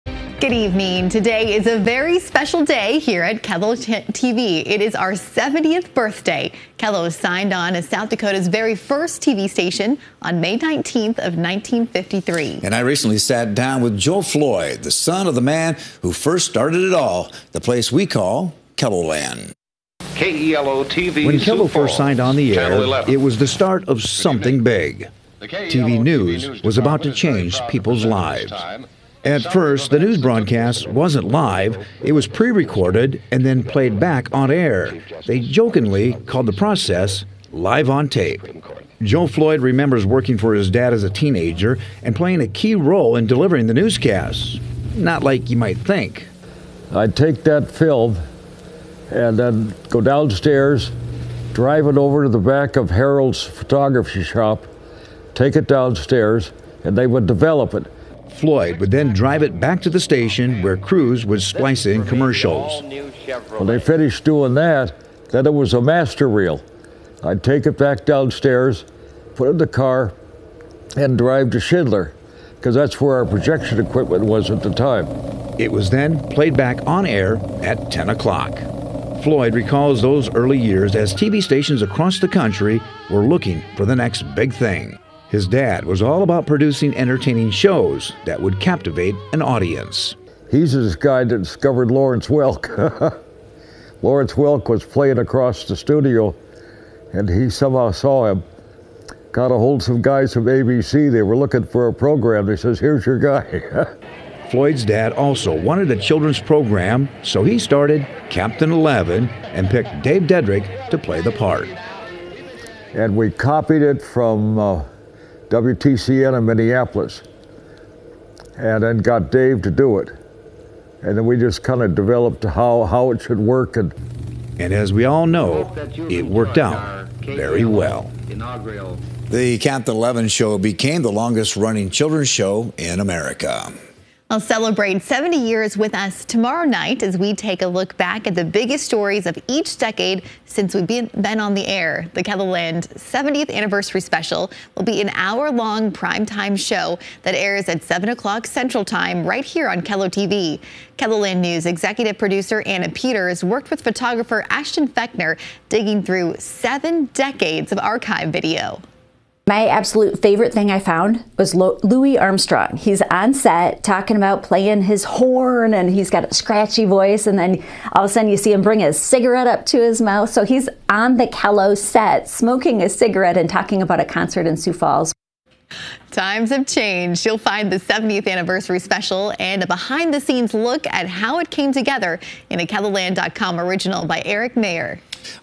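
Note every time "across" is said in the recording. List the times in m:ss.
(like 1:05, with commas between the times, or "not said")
1:21, 1:35.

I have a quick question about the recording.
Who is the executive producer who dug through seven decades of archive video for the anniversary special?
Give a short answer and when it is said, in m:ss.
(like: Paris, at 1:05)
Anna Peters, at 2:32.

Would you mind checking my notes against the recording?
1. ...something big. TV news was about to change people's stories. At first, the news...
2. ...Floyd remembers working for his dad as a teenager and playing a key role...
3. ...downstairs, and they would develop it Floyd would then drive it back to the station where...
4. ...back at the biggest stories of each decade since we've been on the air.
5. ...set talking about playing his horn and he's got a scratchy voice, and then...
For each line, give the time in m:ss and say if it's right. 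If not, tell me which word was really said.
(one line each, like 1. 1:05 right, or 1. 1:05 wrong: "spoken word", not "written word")
1. 0:24 wrong: "lives", not "stories"
2. 0:39 right
3. 0:55 right
4. 2:17 right
5. 2:43 right.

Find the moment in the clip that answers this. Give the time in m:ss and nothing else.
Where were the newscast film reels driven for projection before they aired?
1:11.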